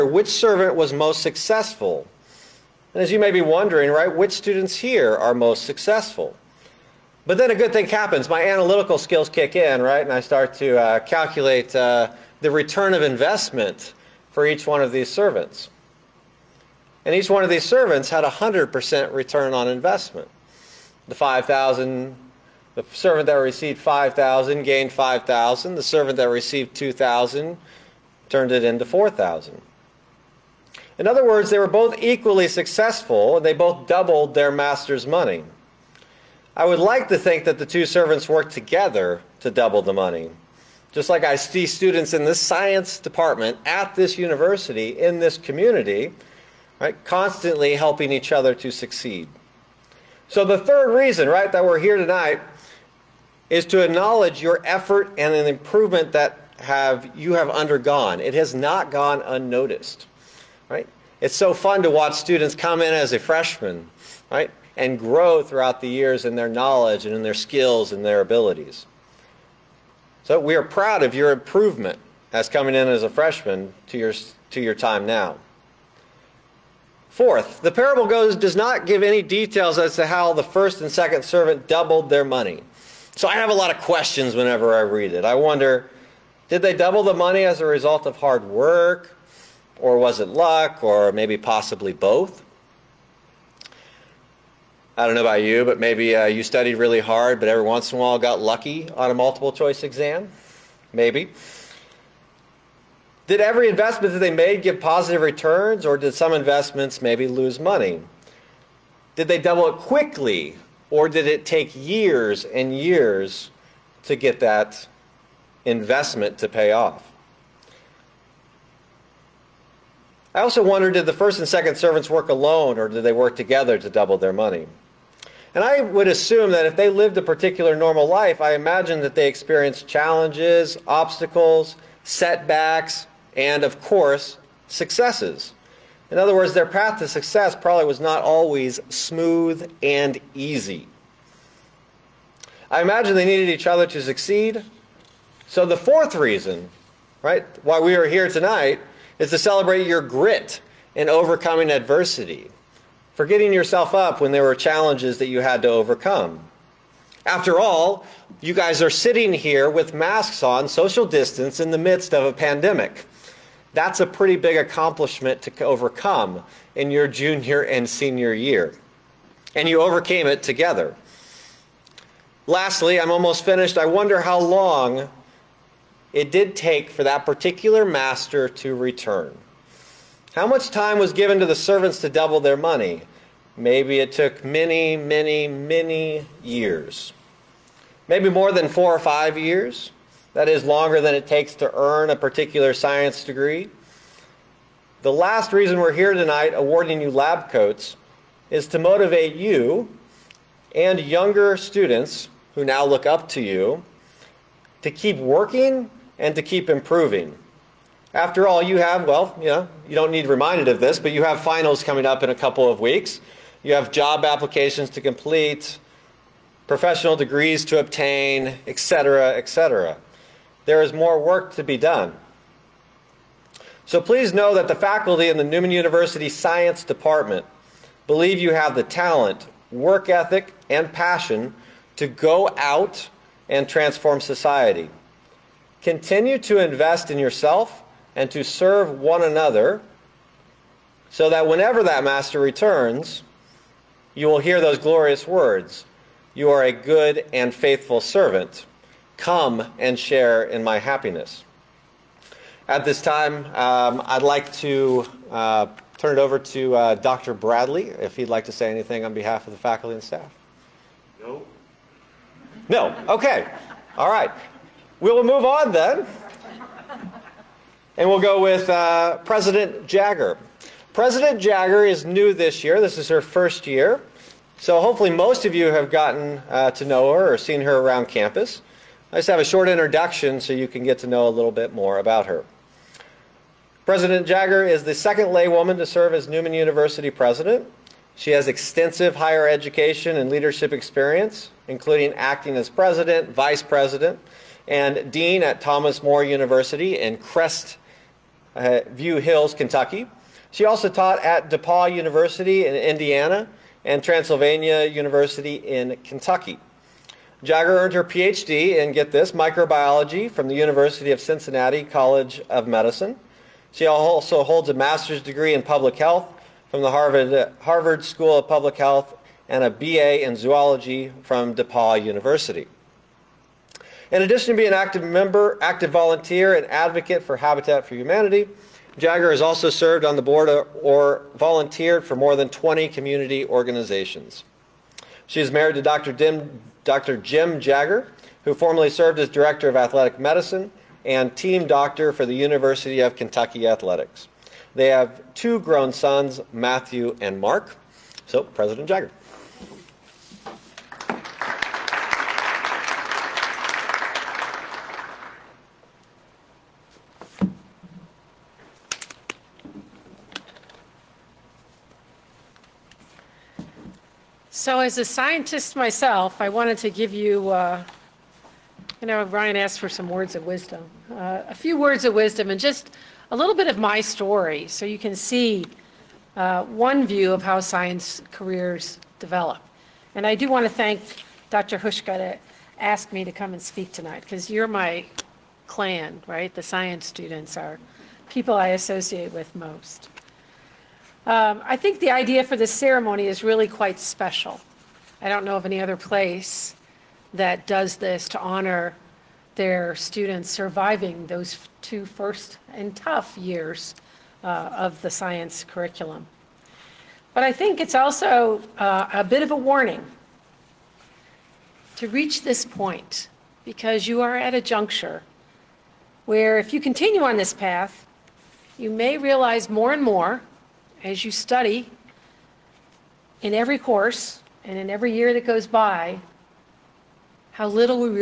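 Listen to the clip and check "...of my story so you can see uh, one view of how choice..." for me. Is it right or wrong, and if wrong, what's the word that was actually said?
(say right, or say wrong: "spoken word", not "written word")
wrong: "science", not "choice".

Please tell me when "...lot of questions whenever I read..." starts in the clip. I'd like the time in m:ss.
1:23.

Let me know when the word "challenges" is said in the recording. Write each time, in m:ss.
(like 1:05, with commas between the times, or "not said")
2:09, 2:34.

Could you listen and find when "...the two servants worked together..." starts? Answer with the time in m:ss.
0:37.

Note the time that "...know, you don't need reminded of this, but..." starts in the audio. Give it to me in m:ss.
3:29.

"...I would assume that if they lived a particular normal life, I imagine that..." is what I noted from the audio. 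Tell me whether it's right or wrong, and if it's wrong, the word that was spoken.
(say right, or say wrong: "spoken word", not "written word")
right.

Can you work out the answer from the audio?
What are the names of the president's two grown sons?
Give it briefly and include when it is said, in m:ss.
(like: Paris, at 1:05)
Matthew and Mark, at 5:46.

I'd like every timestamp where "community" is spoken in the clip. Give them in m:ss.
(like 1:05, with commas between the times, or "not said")
0:45, 5:32.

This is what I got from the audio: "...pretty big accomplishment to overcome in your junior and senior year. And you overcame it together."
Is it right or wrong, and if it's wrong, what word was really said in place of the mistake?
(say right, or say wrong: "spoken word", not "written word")
right.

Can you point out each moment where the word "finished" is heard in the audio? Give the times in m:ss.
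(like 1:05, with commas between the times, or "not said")
2:53.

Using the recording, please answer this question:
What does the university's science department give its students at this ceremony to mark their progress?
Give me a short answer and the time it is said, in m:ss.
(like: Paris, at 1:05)
Lab coats, at 3:17.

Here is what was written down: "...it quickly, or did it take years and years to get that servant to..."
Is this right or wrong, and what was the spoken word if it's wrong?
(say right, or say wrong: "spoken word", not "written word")
wrong: "investment", not "servant".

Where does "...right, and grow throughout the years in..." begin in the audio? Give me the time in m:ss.
1:04.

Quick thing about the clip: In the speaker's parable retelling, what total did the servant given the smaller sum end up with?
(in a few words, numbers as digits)
4,000.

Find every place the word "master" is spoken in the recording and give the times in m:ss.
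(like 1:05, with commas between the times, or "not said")
0:34, 2:57, 4:02, 5:14.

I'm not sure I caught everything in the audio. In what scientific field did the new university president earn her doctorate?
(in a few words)
Microbiology.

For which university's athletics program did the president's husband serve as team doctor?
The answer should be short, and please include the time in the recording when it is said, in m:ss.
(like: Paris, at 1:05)
University of Kentucky, at 5:42.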